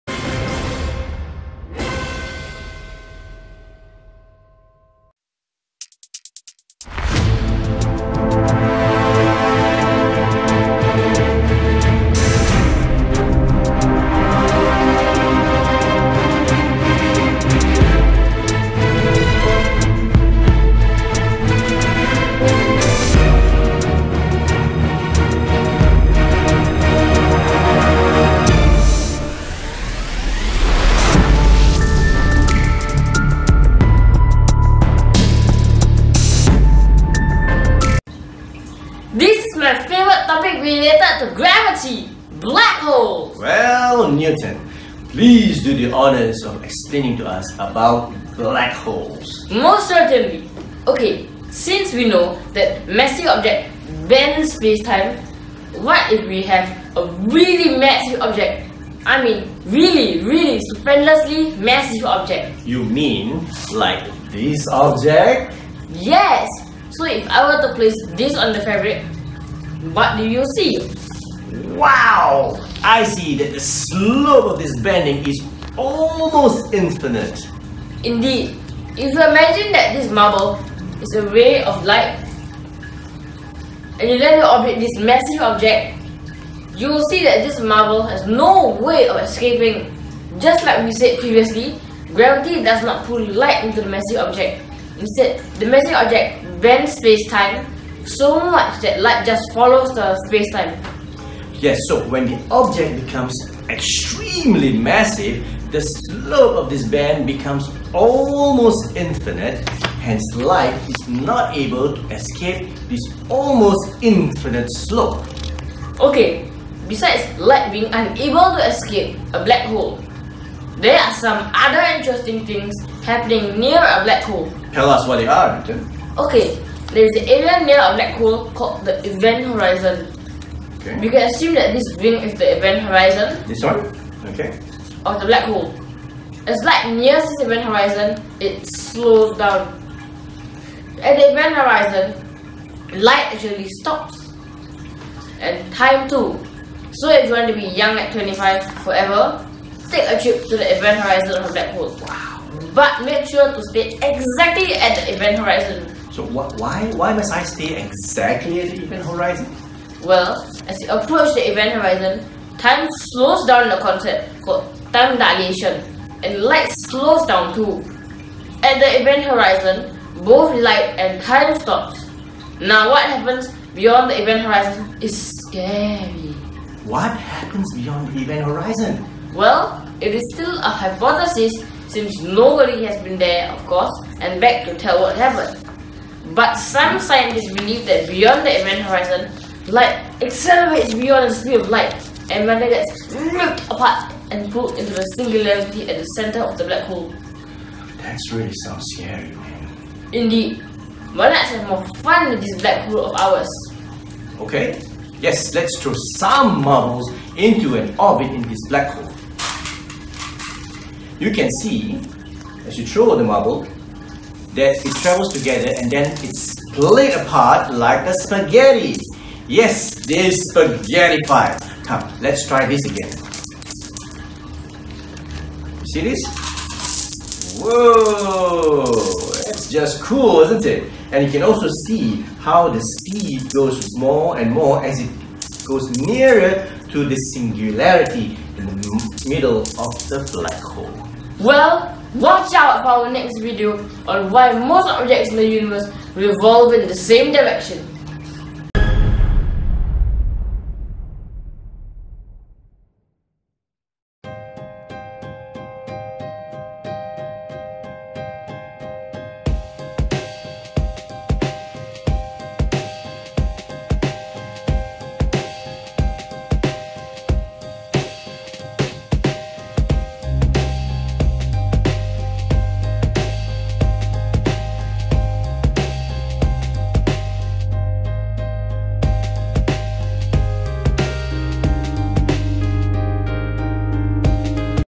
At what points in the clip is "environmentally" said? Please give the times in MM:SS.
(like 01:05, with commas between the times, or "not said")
not said.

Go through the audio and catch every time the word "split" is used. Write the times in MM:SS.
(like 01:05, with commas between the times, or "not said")
03:36.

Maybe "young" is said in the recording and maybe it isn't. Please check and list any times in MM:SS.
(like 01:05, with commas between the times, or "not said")
02:27.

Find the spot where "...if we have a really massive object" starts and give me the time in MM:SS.
00:56.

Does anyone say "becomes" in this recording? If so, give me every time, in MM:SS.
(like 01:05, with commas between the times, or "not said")
01:43, 01:47.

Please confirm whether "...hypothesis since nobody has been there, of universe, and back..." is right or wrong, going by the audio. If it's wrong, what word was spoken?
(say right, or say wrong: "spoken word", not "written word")
wrong: "course", not "universe".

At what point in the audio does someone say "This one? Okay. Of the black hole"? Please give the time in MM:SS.
02:13.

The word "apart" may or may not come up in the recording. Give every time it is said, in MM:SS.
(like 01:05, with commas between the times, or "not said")
03:13, 03:37.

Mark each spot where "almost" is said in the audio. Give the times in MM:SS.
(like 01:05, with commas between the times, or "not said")
01:15, 01:47, 01:53.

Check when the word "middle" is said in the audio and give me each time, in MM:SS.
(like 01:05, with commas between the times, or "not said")
03:59.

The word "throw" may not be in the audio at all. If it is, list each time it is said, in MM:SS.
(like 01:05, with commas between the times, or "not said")
03:25, 03:32.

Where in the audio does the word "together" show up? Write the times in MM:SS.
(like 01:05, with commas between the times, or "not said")
03:35.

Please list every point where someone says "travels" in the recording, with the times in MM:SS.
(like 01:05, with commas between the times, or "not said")
03:35.